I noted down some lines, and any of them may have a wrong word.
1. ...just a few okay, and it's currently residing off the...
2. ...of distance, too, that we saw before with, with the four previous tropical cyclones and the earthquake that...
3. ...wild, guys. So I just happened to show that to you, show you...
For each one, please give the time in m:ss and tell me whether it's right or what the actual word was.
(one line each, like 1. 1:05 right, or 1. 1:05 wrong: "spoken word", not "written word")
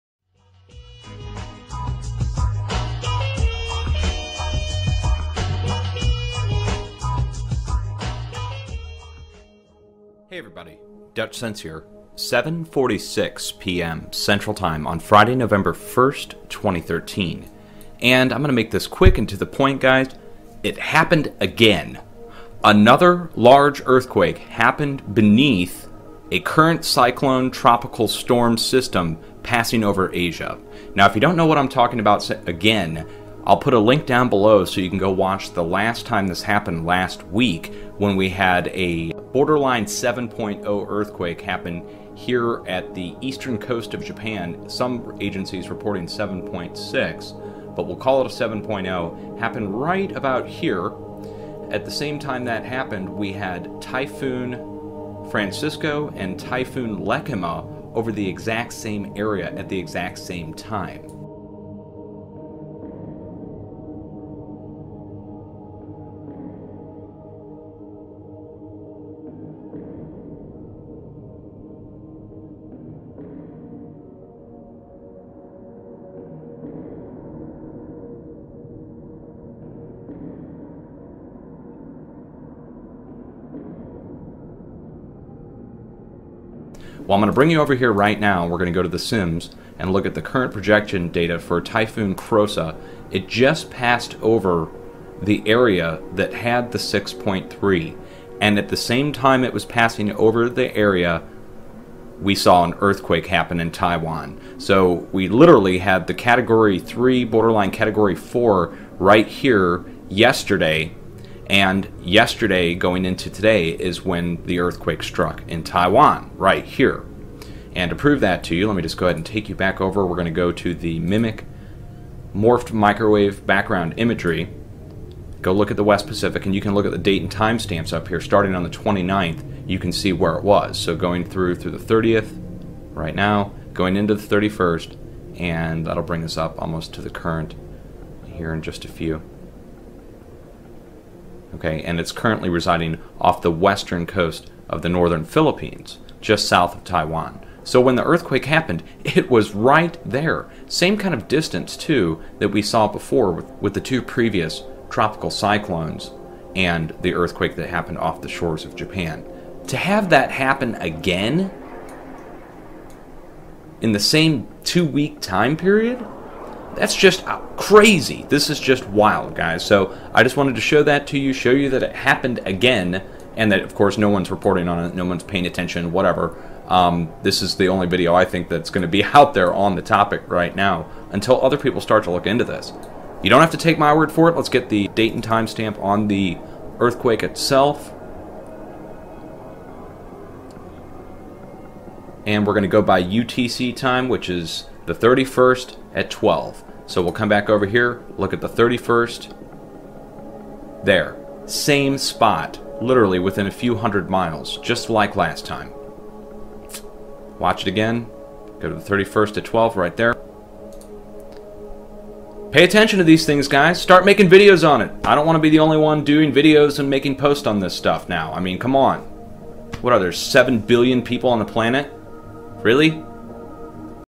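1. 2:18 right
2. 2:31 wrong: "two", not "four"
3. 2:48 wrong: "wanted", not "happened".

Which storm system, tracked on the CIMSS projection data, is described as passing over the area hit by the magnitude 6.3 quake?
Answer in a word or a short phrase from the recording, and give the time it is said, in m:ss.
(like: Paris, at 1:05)
Typhoon Krosa, at 1:31.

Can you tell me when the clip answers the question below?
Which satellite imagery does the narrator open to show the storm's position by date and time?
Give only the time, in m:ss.
2:01.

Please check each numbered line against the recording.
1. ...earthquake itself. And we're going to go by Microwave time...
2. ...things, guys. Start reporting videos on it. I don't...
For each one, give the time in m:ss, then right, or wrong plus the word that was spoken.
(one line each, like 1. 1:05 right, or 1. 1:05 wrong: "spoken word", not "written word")
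1. 3:06 wrong: "UTC", not "Microwave"
2. 3:33 wrong: "making", not "reporting".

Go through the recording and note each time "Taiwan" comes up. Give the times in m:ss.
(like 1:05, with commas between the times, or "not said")
1:43, 1:55, 2:26.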